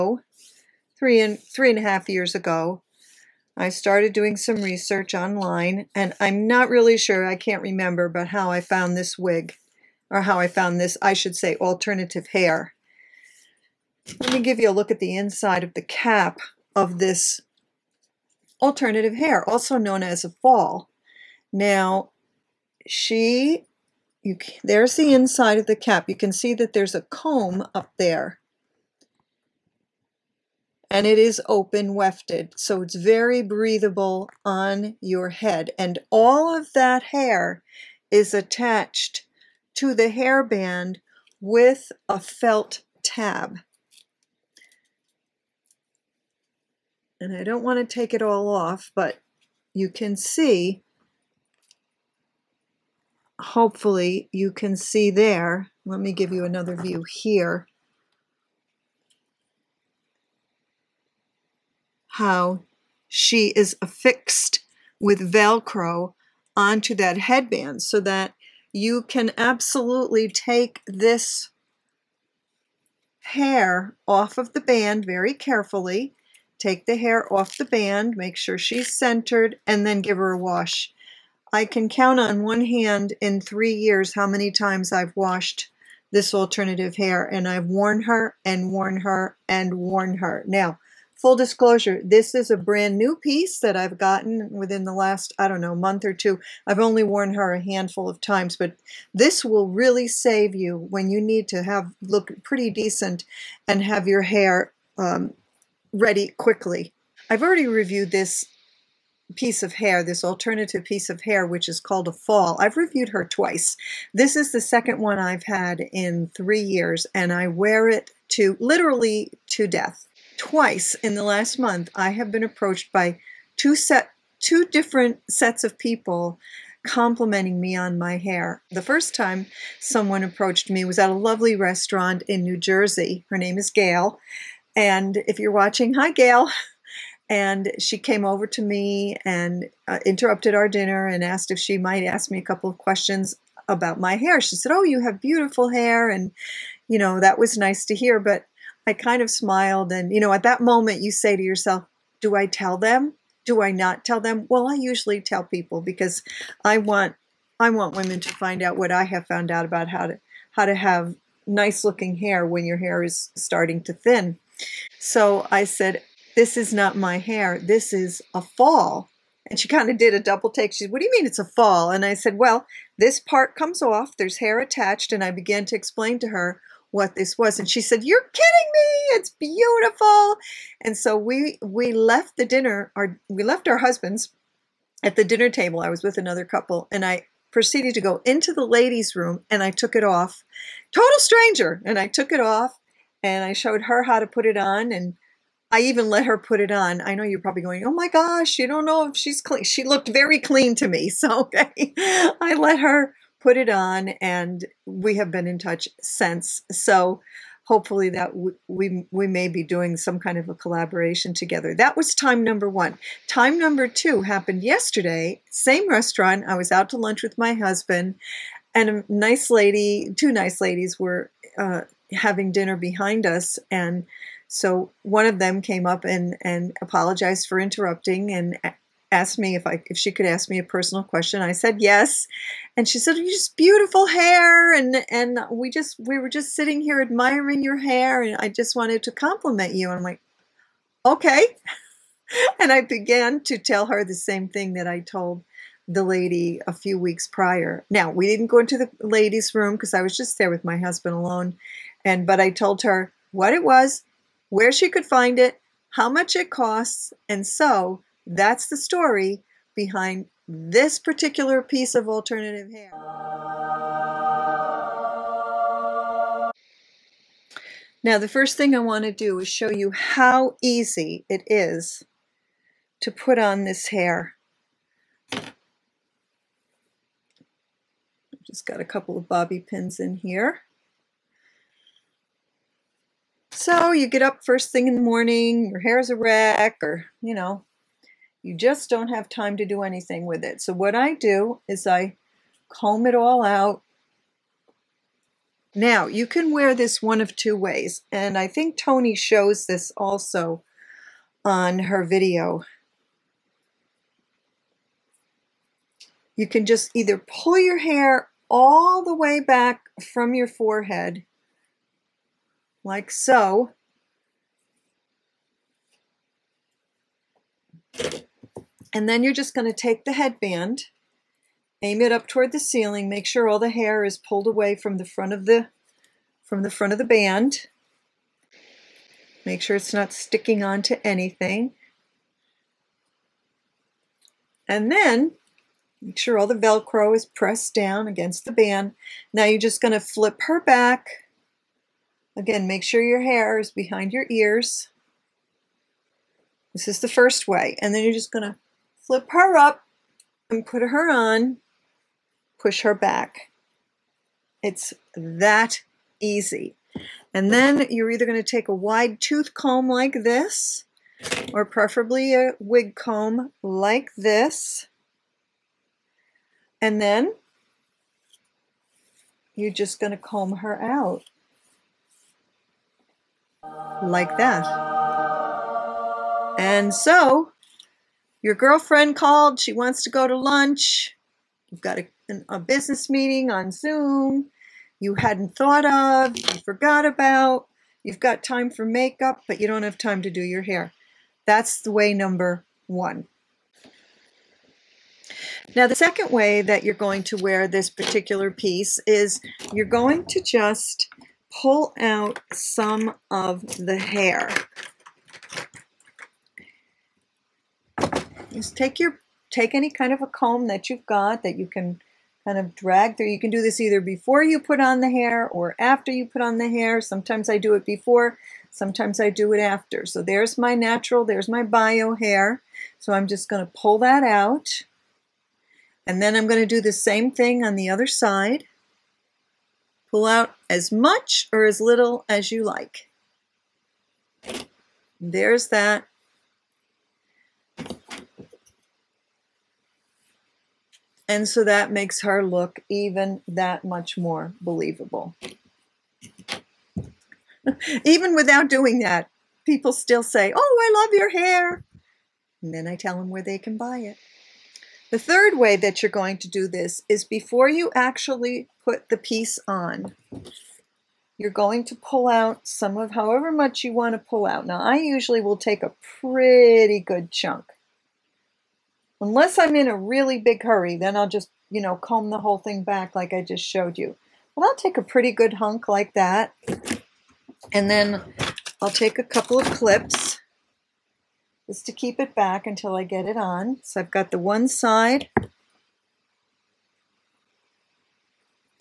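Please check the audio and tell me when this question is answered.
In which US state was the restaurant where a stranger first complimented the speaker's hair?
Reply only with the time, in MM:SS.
02:12.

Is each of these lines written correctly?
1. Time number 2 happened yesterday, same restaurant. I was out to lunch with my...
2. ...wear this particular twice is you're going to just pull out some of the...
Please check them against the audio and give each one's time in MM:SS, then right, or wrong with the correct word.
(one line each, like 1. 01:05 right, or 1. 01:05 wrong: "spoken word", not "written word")
1. 03:33 right
2. 06:37 wrong: "piece", not "twice".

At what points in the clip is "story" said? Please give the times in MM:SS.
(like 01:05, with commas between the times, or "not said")
04:18.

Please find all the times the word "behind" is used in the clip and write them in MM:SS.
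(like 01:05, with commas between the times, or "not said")
03:42, 04:19, 05:43.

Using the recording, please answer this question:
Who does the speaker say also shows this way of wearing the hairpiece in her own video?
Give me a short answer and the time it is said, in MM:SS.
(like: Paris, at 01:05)
Toni, at 04:58.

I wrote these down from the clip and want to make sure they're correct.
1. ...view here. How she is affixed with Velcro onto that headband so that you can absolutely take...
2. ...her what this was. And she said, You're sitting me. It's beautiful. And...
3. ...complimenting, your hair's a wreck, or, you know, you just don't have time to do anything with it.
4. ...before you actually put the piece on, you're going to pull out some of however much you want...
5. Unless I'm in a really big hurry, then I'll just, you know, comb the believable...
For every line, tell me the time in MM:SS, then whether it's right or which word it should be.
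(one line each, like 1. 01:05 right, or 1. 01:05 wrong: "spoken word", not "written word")
1. 00:56 right
2. 02:56 wrong: "kidding", not "sitting"
3. 04:45 wrong: "morning", not "complimenting"
4. 07:37 right
5. 07:49 wrong: "whole", not "believable".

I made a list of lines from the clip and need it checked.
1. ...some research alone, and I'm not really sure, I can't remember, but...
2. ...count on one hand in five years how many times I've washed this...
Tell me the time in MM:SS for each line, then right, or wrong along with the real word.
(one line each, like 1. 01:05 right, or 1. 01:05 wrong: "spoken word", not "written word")
1. 00:04 wrong: "online", not "alone"
2. 01:21 wrong: "three", not "five".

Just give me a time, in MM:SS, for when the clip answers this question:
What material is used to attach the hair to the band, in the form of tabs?
00:42.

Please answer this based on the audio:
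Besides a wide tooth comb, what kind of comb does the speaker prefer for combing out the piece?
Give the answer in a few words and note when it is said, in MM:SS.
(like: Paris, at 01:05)
a wig comb, at 06:02.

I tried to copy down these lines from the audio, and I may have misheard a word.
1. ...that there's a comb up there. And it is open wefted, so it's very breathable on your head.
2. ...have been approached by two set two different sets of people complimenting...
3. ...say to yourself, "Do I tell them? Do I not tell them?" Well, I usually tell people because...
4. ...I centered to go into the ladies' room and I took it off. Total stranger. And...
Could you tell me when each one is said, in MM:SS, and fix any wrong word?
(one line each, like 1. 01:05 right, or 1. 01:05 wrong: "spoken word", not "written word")
1. 00:26 right
2. 02:02 right
3. 02:31 right
4. 03:07 wrong: "proceeded", not "centered".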